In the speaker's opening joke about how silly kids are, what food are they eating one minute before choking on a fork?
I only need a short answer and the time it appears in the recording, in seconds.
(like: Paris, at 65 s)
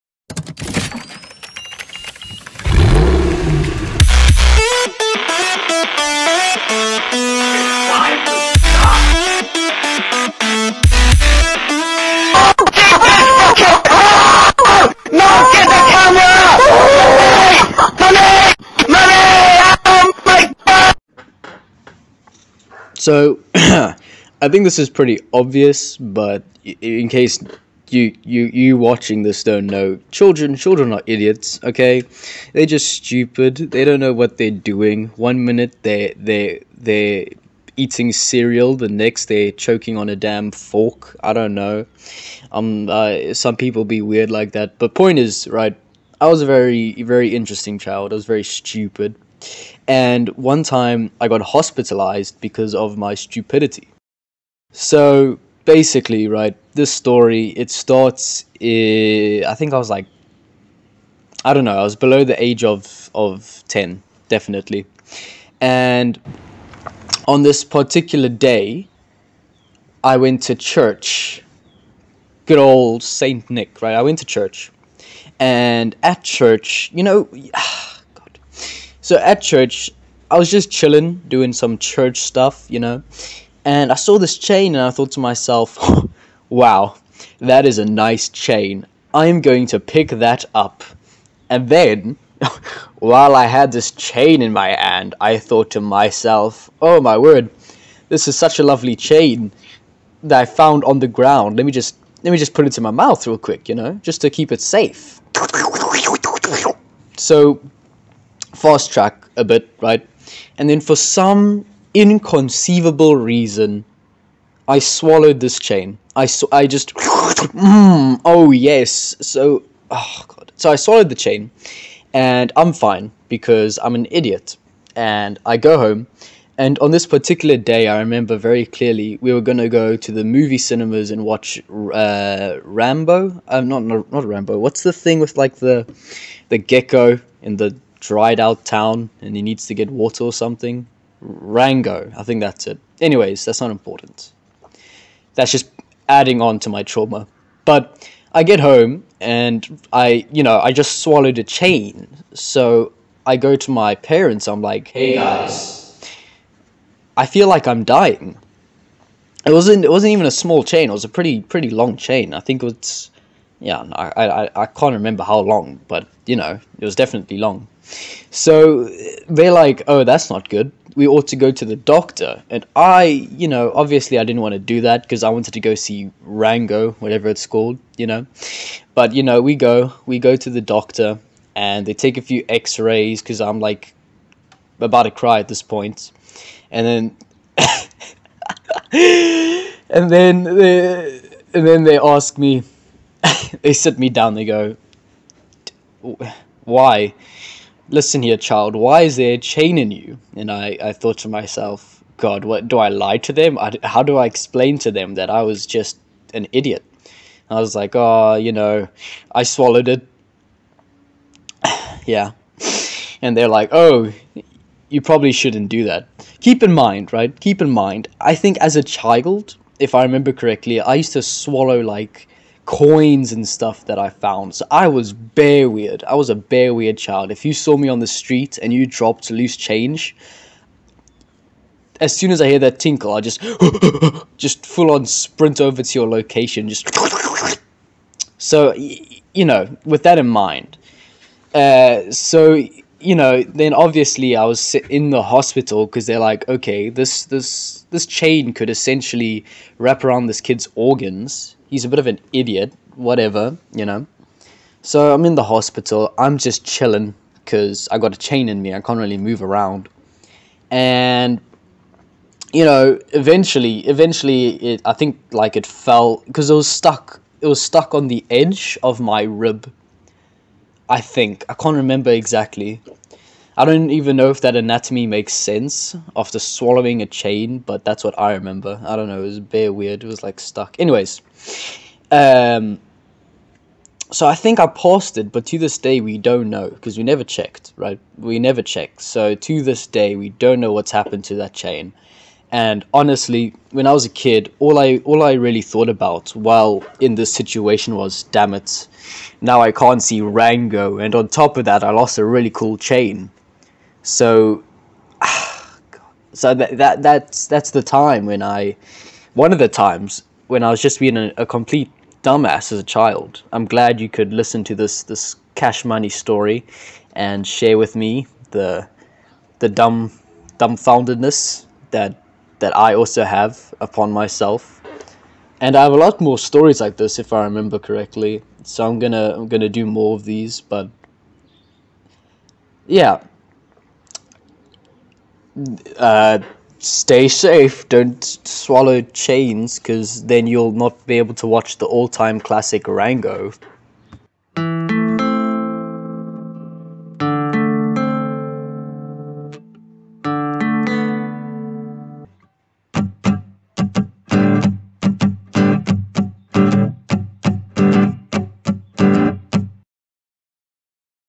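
cereal, at 38 s.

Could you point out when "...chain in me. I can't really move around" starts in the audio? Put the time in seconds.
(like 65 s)
258 s.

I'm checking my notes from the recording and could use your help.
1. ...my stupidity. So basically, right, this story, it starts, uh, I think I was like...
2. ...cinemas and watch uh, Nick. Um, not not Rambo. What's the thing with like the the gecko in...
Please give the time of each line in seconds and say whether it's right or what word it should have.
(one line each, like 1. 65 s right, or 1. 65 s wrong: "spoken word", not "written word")
1. 52 s right
2. 130 s wrong: "Rambo", not "Nick".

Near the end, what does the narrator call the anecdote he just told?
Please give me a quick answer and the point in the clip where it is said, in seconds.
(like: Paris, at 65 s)
Cash Money story, at 315 s.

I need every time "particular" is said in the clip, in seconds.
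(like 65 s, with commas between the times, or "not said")
67 s, 127 s.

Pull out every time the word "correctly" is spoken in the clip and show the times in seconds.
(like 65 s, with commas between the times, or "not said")
220 s, 327 s.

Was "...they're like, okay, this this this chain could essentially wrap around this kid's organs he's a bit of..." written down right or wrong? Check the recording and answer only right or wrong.
right.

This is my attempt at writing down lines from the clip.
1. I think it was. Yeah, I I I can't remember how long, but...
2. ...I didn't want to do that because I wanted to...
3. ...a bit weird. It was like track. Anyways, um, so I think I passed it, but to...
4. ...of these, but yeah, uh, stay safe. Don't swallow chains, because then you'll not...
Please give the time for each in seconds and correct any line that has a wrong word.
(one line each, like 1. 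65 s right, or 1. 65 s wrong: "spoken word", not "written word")
1. 162 s right
2. 174 s right
3. 279 s wrong: "stuck", not "track"
4. 330 s right.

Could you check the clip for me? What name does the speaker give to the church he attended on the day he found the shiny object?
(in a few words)
Saint Nick.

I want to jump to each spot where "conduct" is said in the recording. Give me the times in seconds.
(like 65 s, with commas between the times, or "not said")
not said.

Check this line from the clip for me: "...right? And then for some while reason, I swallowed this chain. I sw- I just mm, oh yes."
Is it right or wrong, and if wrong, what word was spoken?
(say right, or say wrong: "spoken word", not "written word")
wrong: "inconceivable", not "while".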